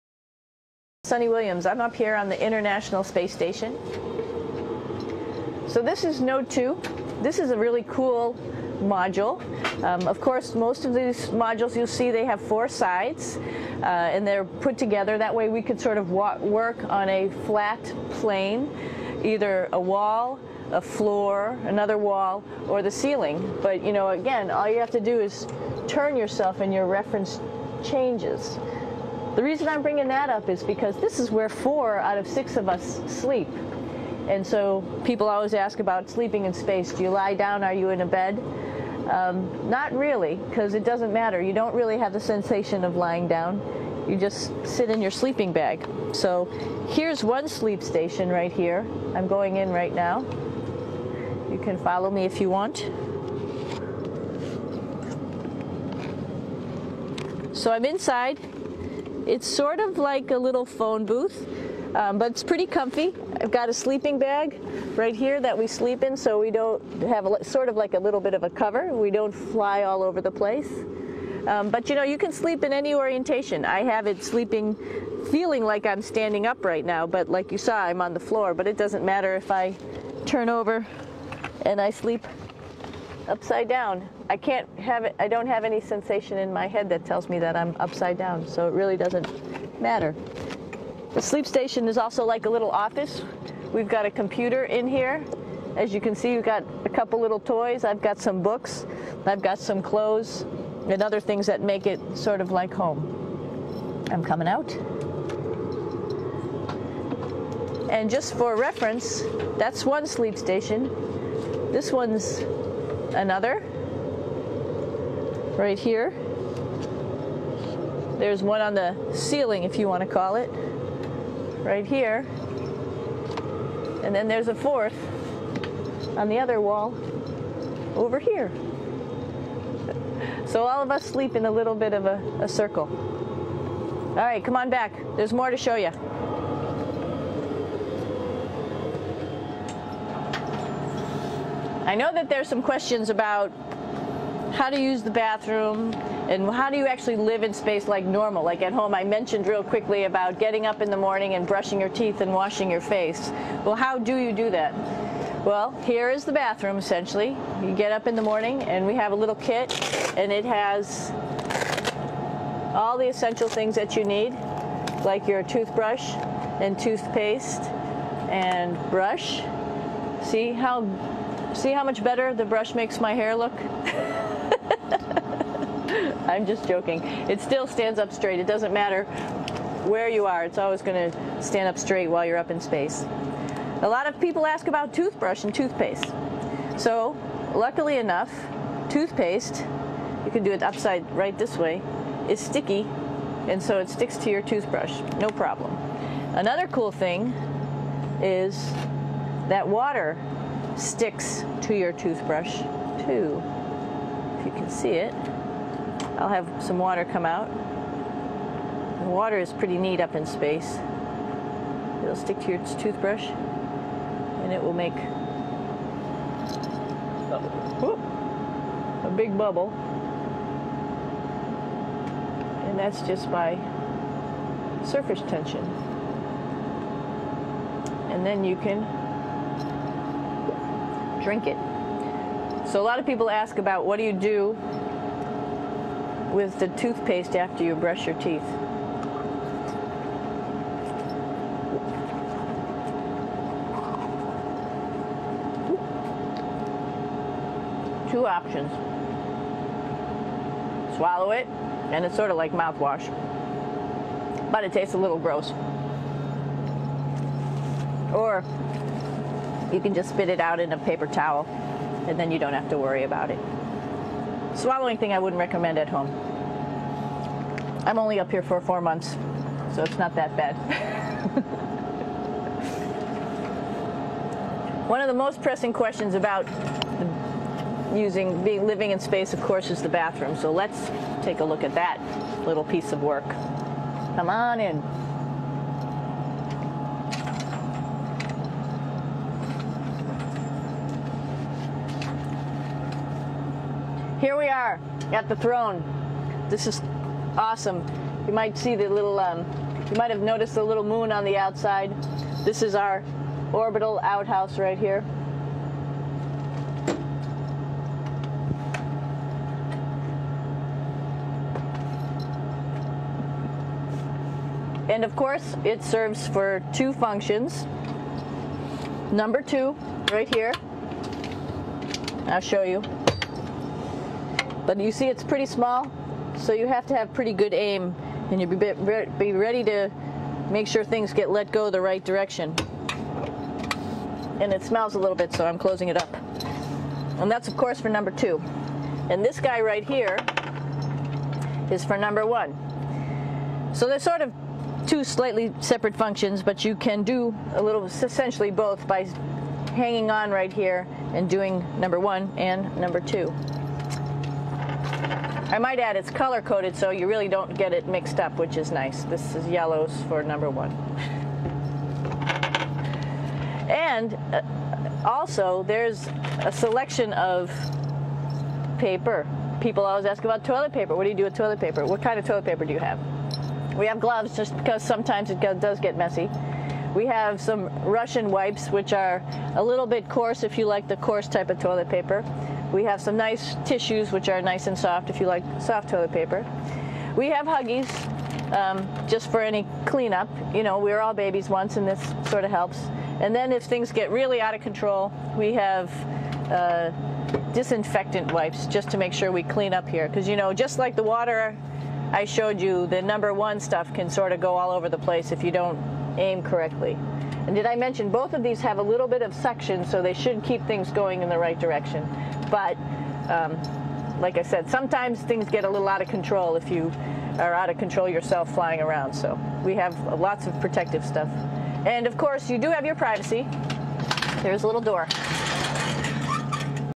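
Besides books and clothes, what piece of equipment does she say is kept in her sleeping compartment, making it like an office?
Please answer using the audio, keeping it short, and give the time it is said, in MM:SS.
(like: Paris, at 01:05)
A computer, at 01:34.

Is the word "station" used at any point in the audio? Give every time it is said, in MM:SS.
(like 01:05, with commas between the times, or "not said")
00:03, 00:47, 01:31, 01:50.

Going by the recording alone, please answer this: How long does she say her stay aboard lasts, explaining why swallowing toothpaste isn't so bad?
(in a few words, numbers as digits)
4 months.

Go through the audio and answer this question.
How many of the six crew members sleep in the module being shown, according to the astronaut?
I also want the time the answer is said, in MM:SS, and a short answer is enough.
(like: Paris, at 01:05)
4, at 00:31.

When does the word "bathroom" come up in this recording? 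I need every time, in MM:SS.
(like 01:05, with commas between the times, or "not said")
02:25, 02:36, 04:39.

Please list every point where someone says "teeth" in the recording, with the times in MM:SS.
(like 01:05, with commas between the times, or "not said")
02:31, 03:58.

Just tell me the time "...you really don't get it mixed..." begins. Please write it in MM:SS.
05:56.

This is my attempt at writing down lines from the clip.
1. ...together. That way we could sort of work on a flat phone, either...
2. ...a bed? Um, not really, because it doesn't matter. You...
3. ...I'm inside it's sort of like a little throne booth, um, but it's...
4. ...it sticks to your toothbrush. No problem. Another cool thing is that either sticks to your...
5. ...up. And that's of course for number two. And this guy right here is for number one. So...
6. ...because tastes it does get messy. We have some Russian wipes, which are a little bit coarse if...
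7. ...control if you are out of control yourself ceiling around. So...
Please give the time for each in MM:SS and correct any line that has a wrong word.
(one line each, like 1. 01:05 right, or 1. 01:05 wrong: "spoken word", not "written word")
1. 00:14 wrong: "plane", not "phone"
2. 00:38 right
3. 00:57 wrong: "phone", not "throne"
4. 03:13 wrong: "water", not "either"
5. 05:35 right
6. 06:14 wrong: "sometimes", not "tastes"
7. 06:56 wrong: "flying", not "ceiling".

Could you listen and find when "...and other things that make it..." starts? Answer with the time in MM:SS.
01:40.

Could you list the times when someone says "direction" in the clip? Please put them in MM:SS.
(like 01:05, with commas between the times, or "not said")
05:32, 06:51.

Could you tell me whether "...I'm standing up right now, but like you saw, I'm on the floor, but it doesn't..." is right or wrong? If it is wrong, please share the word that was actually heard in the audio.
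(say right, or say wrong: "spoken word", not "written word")
right.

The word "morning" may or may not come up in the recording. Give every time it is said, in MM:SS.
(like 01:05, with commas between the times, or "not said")
02:30, 02:38.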